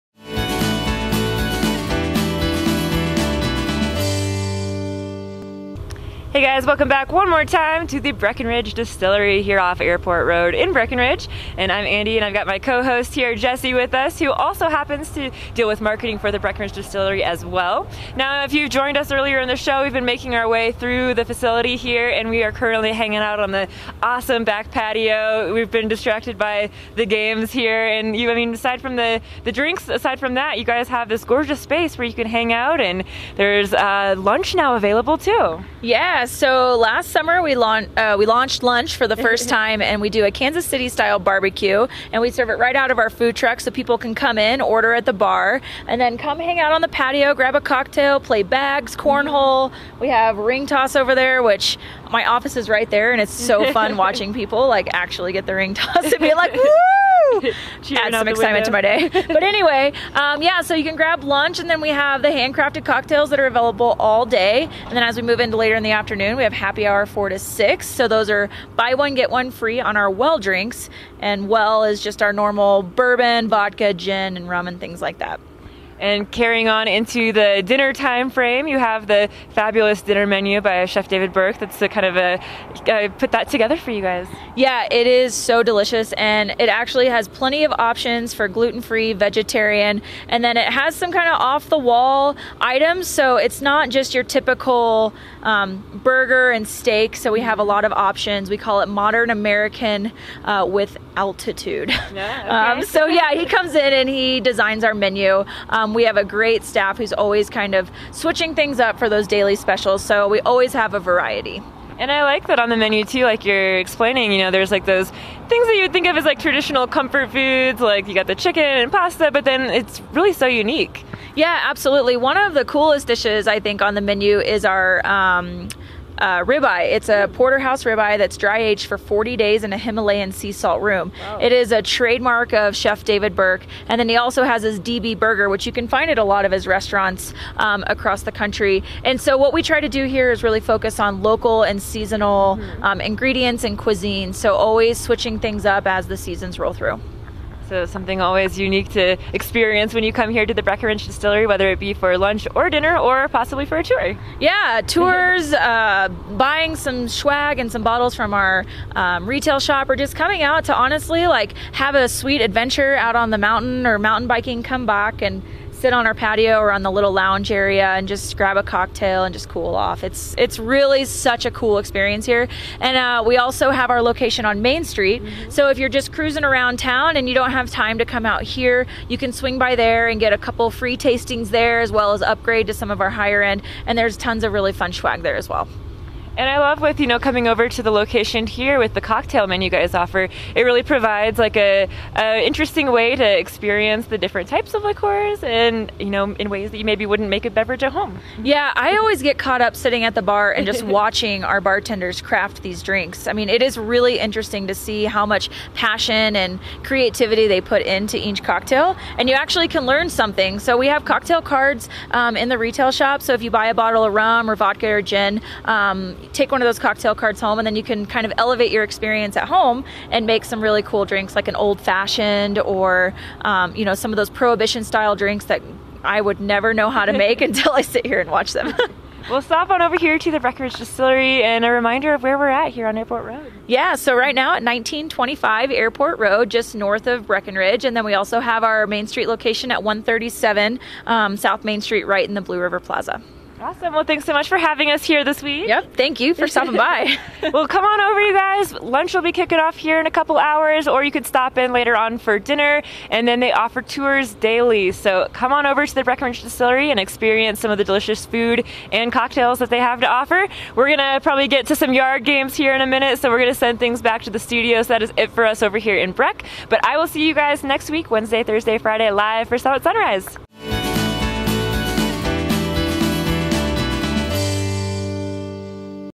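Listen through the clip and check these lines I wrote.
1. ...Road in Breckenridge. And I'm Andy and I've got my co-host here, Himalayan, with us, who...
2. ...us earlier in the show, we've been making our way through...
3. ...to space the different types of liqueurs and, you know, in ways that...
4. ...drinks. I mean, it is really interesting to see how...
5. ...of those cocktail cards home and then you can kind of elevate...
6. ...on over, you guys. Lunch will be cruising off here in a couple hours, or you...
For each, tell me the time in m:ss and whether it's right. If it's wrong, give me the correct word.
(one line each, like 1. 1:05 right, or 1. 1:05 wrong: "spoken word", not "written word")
1. 0:10 wrong: "Jesse", not "Himalayan"
2. 0:18 right
3. 3:13 wrong: "experience", not "space"
4. 3:22 right
5. 3:36 right
6. 4:07 wrong: "kicking", not "cruising".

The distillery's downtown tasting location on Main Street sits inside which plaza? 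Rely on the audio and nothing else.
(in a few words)
Blue River Plaza.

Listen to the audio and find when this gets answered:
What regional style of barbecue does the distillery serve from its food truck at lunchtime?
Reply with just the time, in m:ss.
0:40.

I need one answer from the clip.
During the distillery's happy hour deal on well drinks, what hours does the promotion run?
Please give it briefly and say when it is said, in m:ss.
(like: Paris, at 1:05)
4 to 6, at 1:07.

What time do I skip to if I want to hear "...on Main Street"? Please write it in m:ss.
2:54.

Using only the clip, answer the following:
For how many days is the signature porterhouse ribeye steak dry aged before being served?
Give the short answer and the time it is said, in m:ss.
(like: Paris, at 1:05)
40, at 2:08.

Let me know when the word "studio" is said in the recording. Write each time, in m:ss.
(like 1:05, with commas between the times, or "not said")
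4:24.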